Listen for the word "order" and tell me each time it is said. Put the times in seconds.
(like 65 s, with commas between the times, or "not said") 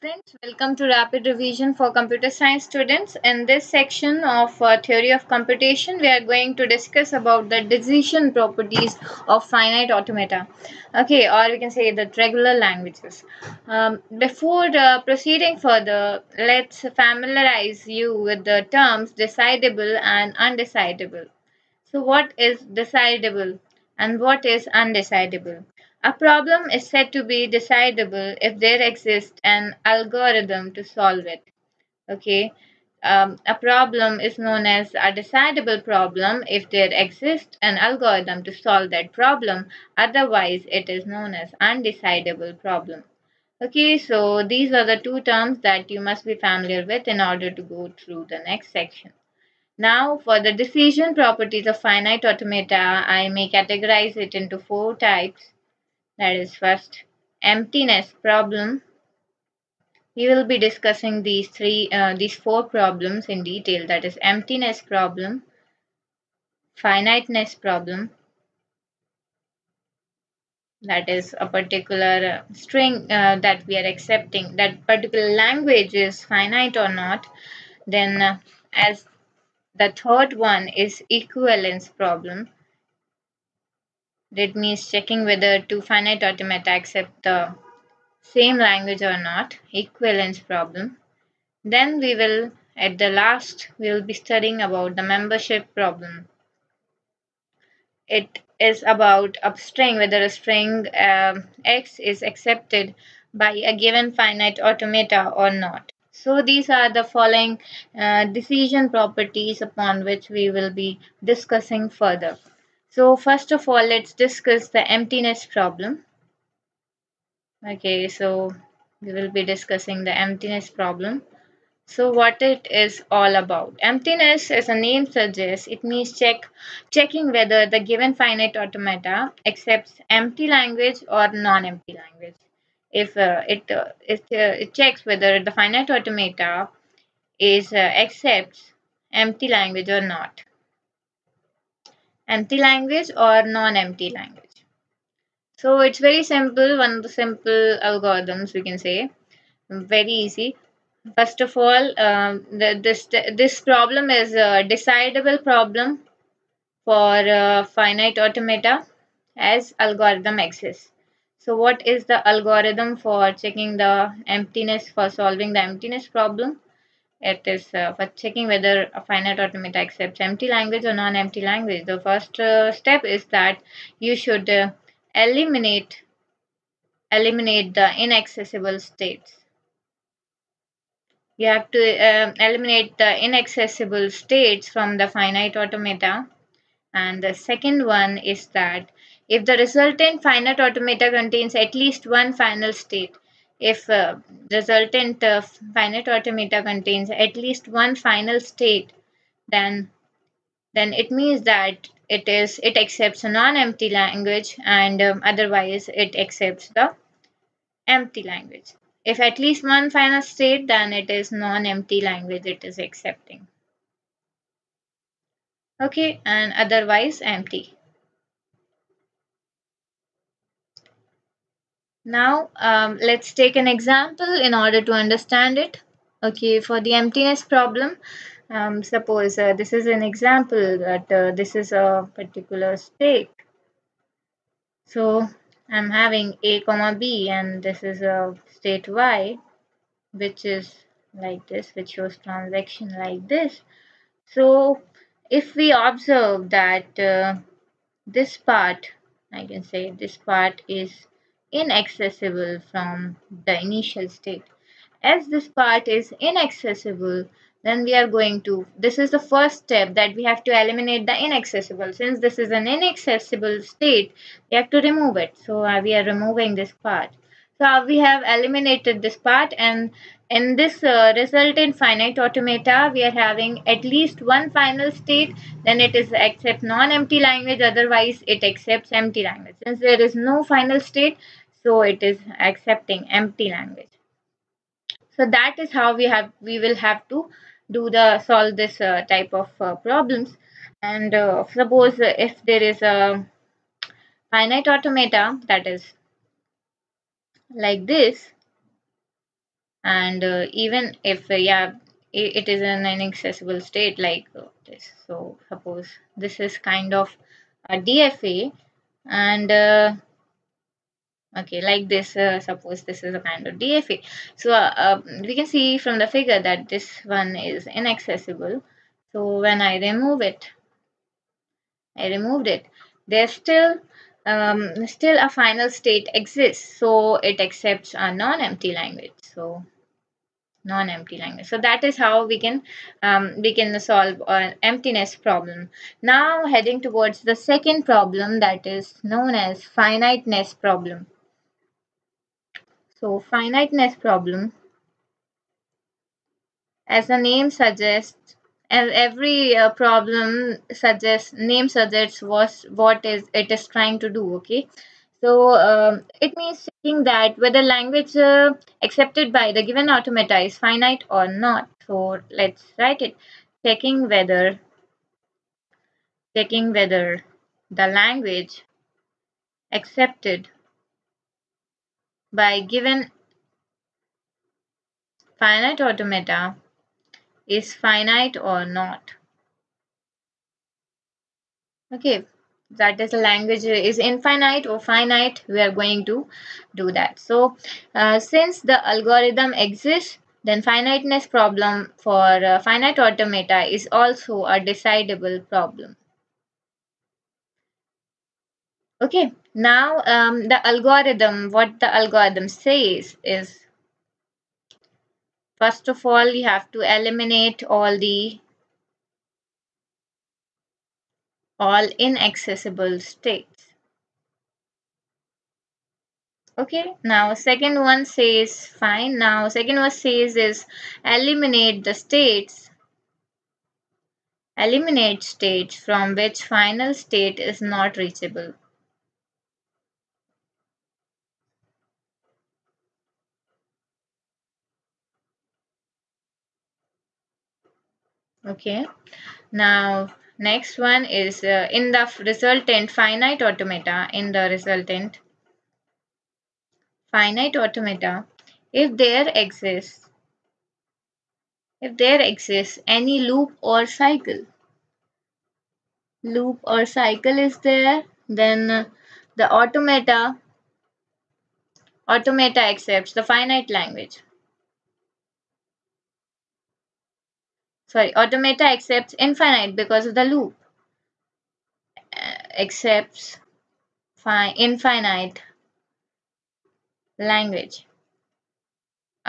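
47 s, 224 s.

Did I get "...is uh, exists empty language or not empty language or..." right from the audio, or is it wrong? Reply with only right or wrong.
wrong.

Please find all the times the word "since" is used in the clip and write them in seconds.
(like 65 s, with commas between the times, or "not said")
261 s, 279 s, 388 s.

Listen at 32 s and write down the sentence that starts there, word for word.
Okay, um, a problem is known as a decidable problem if there exists an algorithm to solve that problem.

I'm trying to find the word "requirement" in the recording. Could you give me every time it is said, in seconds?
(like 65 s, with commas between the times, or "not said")
not said.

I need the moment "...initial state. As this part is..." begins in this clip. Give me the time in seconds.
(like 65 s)
253 s.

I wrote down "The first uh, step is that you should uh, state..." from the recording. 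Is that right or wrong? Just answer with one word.
wrong.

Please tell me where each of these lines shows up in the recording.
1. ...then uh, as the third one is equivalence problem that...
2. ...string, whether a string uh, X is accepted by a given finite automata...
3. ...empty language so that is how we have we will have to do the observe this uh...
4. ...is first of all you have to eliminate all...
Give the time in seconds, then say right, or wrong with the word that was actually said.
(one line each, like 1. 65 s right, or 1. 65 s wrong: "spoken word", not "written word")
1. 77 s right
2. 99 s right
3. 283 s wrong: "solve", not "observe"
4. 403 s right.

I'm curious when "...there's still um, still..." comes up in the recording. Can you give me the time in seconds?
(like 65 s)
323 s.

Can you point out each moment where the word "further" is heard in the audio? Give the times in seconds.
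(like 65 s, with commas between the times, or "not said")
15 s, 111 s.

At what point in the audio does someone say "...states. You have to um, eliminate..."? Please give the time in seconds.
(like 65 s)
178 s.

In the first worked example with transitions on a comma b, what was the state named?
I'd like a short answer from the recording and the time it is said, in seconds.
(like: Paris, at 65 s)
y, at 238 s.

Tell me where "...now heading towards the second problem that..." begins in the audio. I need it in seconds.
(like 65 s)
336 s.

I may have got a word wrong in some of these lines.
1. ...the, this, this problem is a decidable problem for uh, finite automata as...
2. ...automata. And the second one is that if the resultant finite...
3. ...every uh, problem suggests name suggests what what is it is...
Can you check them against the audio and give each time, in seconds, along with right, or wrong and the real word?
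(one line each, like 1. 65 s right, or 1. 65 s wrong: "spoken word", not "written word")
1. 152 s right
2. 185 s right
3. 348 s right.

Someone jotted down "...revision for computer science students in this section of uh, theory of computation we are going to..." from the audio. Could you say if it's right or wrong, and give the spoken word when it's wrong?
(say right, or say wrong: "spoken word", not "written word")
right.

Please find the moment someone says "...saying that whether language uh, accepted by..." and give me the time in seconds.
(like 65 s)
356 s.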